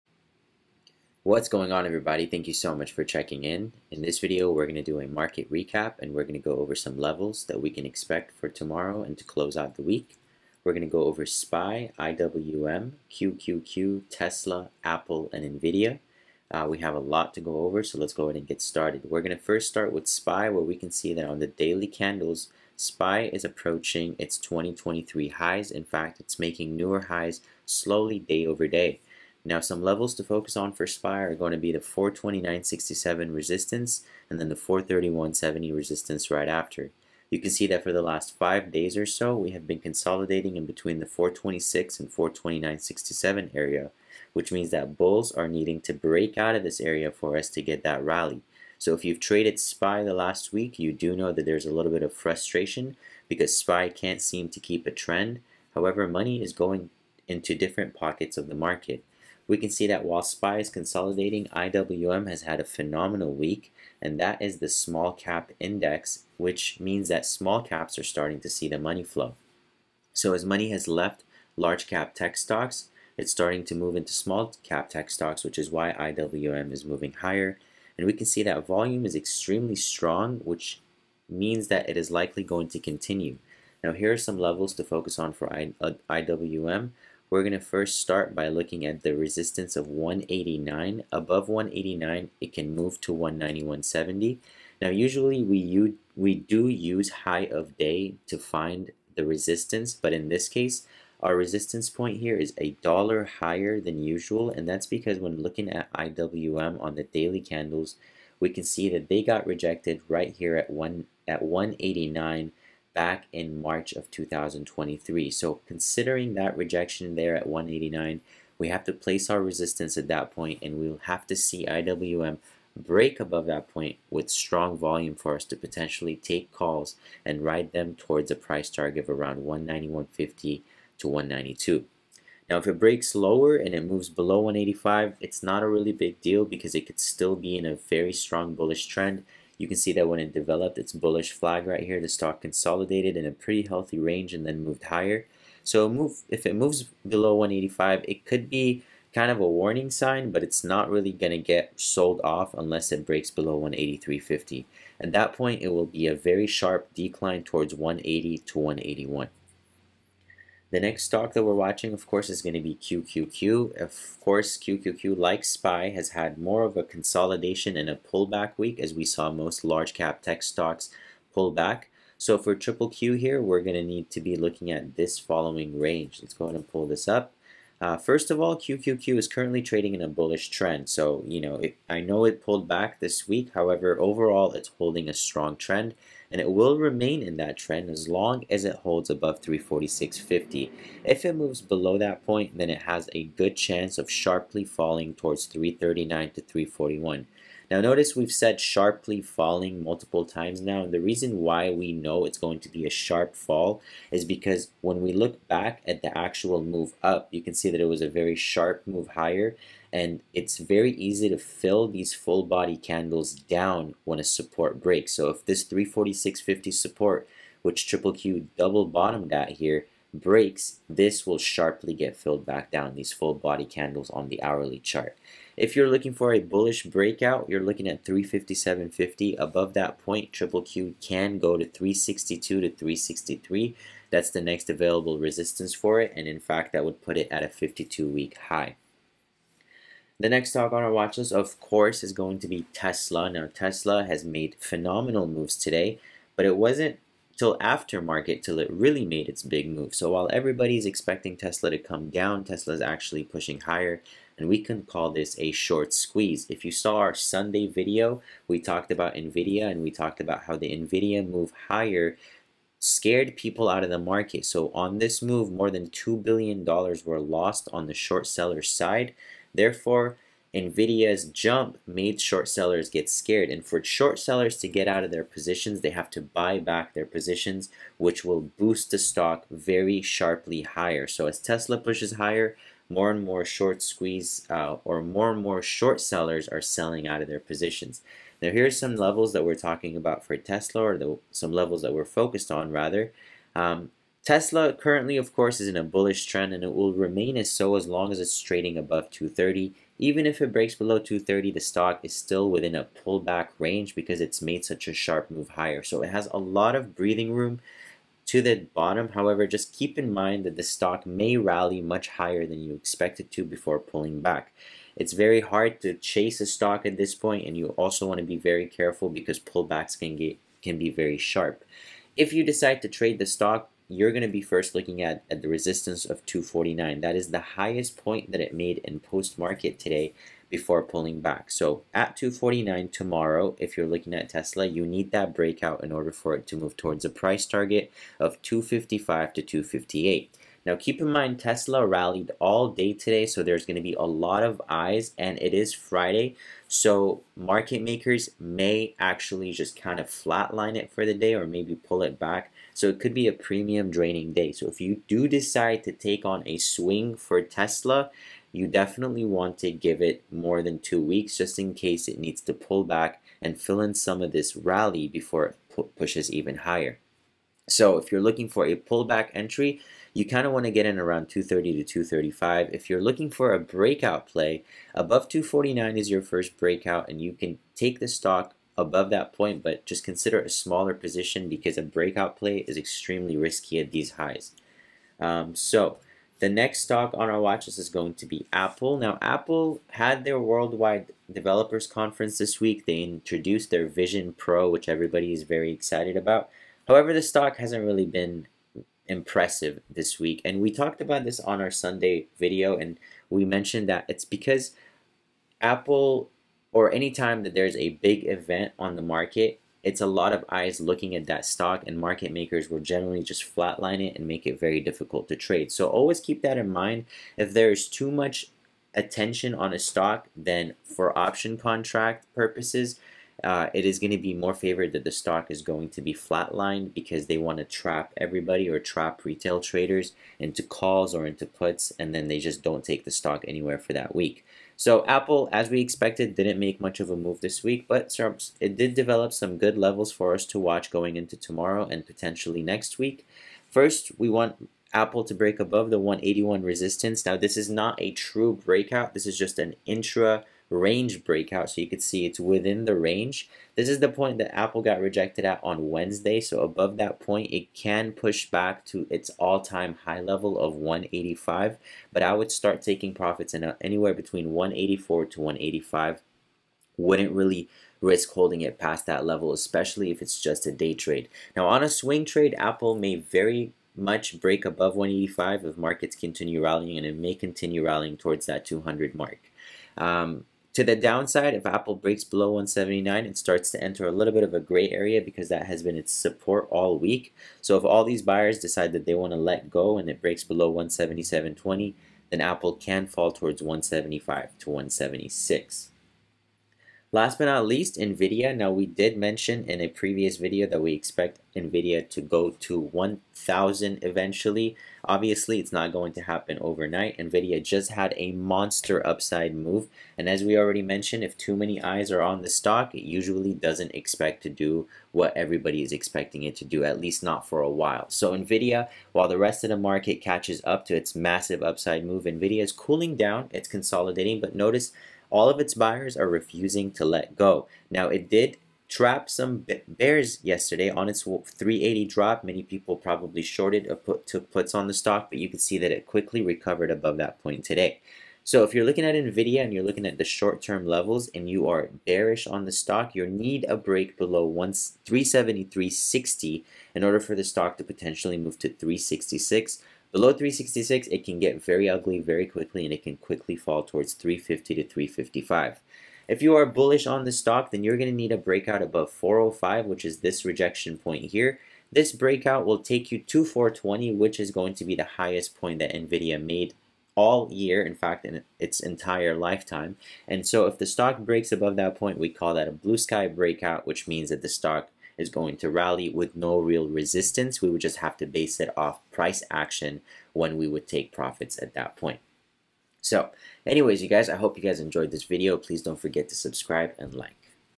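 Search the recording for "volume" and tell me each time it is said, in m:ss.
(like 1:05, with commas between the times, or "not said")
1:18, 2:04.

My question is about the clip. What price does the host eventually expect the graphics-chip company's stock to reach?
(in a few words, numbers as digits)
1,000.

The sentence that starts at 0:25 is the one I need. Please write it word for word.
In fact, it's making newer highs slowly day over day.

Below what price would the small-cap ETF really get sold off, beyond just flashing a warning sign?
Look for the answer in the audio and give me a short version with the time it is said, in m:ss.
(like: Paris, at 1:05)
183.50, at 2:33.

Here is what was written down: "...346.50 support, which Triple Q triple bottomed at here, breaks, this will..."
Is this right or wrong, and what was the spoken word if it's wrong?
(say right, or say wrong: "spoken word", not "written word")
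wrong: "double", not "triple".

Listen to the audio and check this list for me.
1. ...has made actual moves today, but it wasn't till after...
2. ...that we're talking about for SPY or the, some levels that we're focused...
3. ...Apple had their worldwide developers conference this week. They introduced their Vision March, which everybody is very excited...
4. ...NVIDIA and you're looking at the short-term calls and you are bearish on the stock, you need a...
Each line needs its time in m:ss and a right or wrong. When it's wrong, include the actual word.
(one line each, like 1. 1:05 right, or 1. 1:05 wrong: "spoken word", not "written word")
1. 4:04 wrong: "phenomenal", not "actual"
2. 4:49 wrong: "Tesla", not "SPY"
3. 6:29 wrong: "Pro", not "March"
4. 8:59 wrong: "levels", not "calls".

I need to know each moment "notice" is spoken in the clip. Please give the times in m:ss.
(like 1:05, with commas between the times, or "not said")
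3:17, 8:44.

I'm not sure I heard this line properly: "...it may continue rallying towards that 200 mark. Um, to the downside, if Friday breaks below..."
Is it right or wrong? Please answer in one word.
wrong.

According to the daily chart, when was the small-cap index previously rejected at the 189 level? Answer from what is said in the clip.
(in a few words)
March of 2023.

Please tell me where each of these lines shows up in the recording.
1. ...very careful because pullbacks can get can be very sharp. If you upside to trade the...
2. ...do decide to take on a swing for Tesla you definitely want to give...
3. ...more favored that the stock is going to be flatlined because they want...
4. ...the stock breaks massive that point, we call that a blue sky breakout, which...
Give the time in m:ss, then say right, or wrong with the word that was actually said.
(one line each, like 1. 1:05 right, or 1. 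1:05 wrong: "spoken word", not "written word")
1. 5:18 wrong: "decide", not "upside"
2. 5:55 right
3. 7:04 right
4. 9:30 wrong: "above", not "massive".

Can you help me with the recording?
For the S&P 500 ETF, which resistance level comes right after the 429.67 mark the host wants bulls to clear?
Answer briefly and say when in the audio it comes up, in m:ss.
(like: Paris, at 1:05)
431.70, at 0:34.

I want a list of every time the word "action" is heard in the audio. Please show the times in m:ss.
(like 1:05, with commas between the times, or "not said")
9:39.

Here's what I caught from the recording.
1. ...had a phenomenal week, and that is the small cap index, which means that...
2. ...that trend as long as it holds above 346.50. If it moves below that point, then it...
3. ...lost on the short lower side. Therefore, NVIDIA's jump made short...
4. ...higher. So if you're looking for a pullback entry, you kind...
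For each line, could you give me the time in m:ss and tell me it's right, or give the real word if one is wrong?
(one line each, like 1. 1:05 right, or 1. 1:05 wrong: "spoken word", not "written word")
1. 1:02 right
2. 3:07 right
3. 4:27 wrong: "seller", not "lower"
4. 6:06 right.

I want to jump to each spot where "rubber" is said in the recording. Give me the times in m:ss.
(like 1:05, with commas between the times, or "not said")
not said.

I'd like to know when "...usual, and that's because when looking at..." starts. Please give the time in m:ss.
1:44.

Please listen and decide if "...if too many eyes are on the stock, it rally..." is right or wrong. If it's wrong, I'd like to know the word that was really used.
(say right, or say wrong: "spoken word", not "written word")
wrong: "usually", not "rally".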